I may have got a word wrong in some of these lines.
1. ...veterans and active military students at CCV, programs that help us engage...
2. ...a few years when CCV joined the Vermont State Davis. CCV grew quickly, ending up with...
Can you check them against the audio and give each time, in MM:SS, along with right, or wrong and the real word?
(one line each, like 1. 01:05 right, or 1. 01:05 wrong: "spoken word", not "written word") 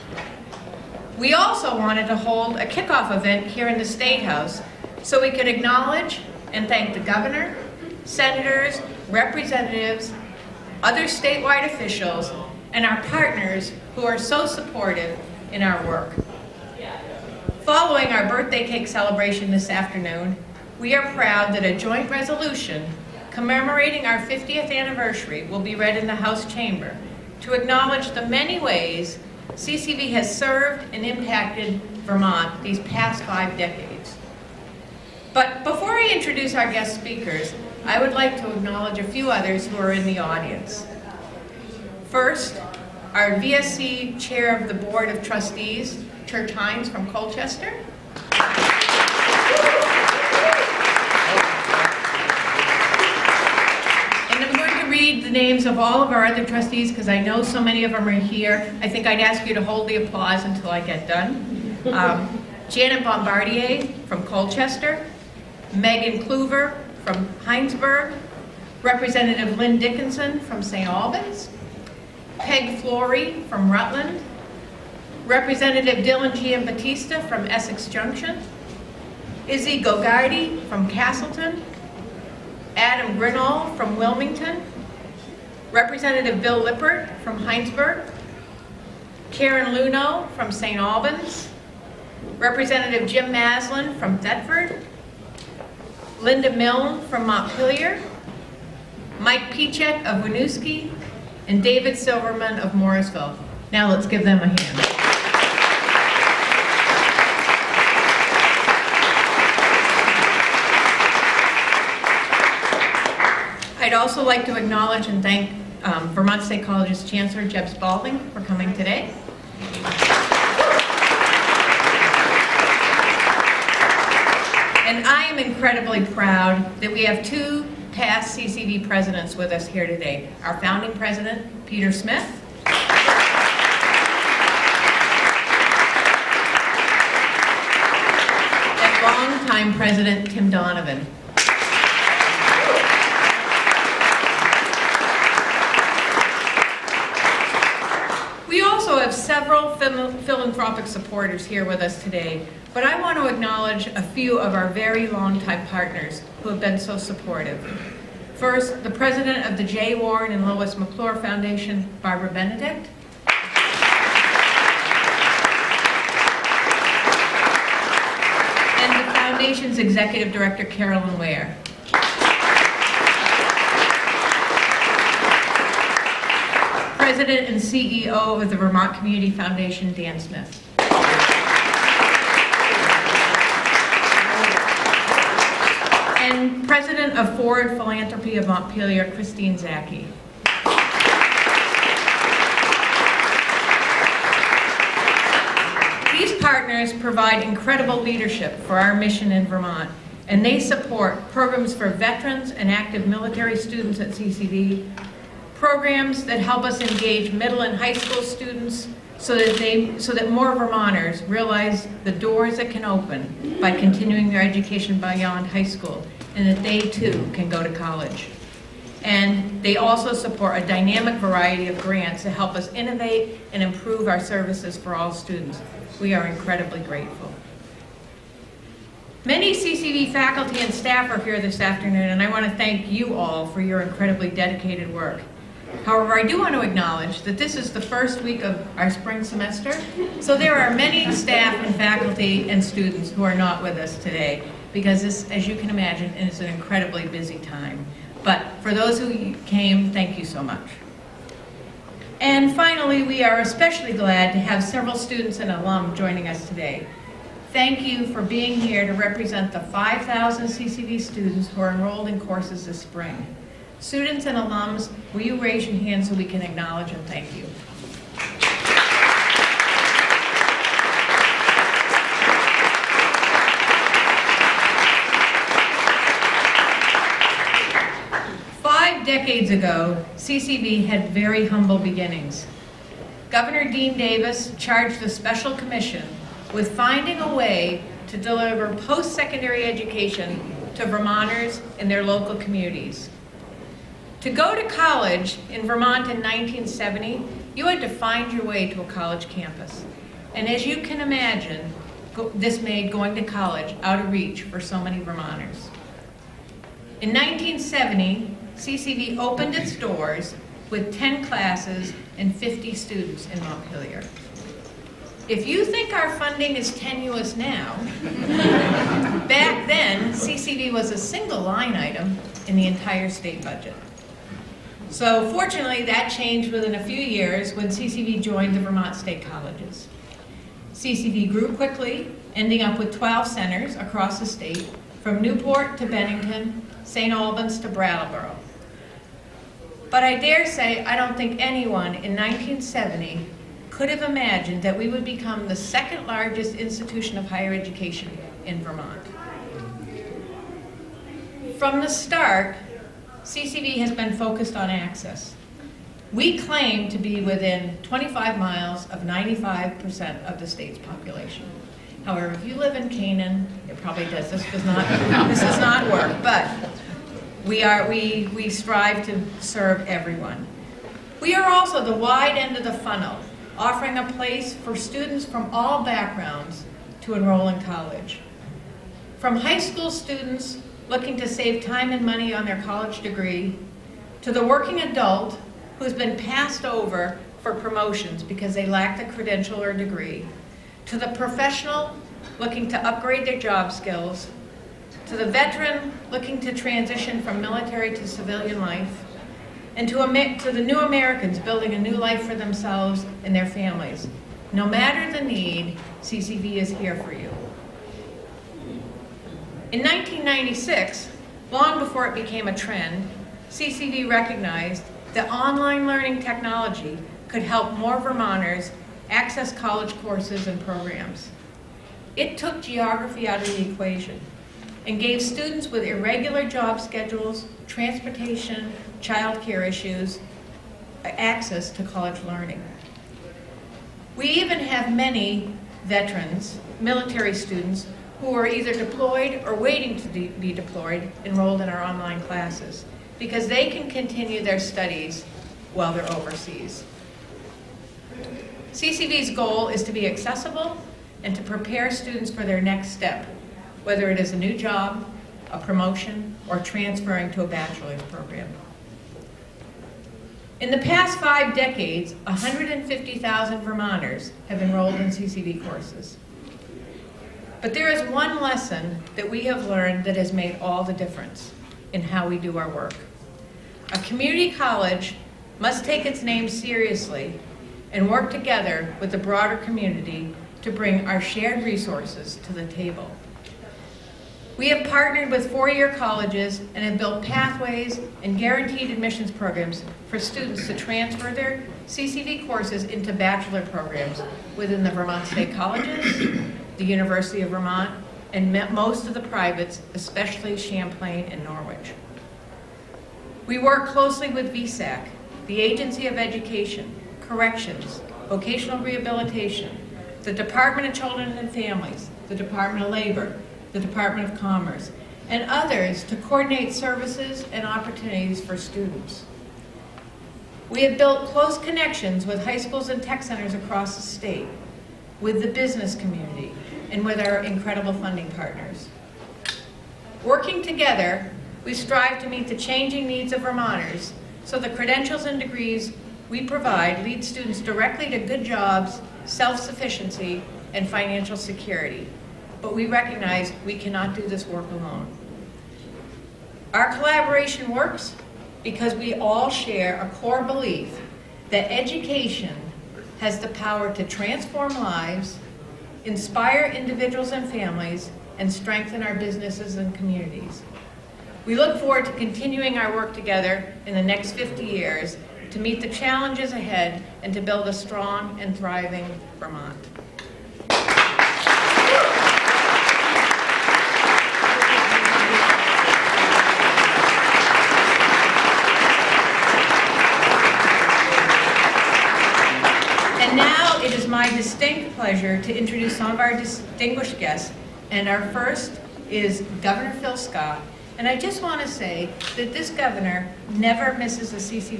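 1. 03:21 right
2. 05:26 wrong: "Colleges", not "Davis".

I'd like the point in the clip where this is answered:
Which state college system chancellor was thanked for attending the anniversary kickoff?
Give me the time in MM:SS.
01:57.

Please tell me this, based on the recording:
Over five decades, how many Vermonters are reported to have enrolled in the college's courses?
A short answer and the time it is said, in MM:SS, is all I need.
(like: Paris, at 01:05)
150,000, at 07:42.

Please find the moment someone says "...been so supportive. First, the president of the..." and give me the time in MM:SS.
02:36.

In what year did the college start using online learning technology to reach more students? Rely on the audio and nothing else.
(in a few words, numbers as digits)
1996.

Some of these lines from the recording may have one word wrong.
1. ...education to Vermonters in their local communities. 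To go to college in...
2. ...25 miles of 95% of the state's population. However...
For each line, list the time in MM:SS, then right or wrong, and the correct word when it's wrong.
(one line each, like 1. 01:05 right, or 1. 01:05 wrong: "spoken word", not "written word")
1. 04:49 right
2. 05:57 right.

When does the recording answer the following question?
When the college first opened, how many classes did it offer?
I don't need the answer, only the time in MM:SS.
05:10.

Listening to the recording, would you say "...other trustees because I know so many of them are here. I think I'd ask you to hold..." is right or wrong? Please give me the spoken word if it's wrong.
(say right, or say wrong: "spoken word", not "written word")
right.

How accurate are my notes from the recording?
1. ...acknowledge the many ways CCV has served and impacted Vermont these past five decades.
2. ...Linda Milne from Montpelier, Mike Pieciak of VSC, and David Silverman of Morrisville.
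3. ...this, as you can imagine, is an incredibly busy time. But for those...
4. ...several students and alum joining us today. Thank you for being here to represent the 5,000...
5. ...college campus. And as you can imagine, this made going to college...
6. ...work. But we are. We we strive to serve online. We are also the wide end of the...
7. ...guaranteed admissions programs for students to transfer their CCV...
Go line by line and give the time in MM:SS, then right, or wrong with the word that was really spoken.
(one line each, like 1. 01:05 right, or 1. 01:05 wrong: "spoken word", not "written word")
1. 00:27 right
2. 01:36 wrong: "Winooski", not "VSC"
3. 04:05 right
4. 04:14 right
5. 04:58 right
6. 06:05 wrong: "everyone", not "online"
7. 08:08 right.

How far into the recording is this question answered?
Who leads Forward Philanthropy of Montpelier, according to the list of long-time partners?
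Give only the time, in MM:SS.
03:09.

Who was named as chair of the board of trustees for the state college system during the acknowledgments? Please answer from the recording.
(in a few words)
Church Hindes.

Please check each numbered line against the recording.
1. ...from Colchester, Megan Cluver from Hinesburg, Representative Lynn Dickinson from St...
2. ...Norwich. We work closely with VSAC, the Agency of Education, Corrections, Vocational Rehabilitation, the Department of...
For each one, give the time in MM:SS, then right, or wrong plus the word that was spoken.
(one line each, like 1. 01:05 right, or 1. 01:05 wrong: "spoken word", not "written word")
1. 01:04 right
2. 08:21 right.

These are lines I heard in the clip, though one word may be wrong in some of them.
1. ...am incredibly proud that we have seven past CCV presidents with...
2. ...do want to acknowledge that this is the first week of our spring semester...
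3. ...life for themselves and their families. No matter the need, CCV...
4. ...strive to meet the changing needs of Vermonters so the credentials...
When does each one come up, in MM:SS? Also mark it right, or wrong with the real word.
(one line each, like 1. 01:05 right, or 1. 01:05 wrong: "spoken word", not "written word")
1. 02:05 wrong: "two", not "seven"
2. 03:56 right
3. 06:41 right
4. 08:51 right.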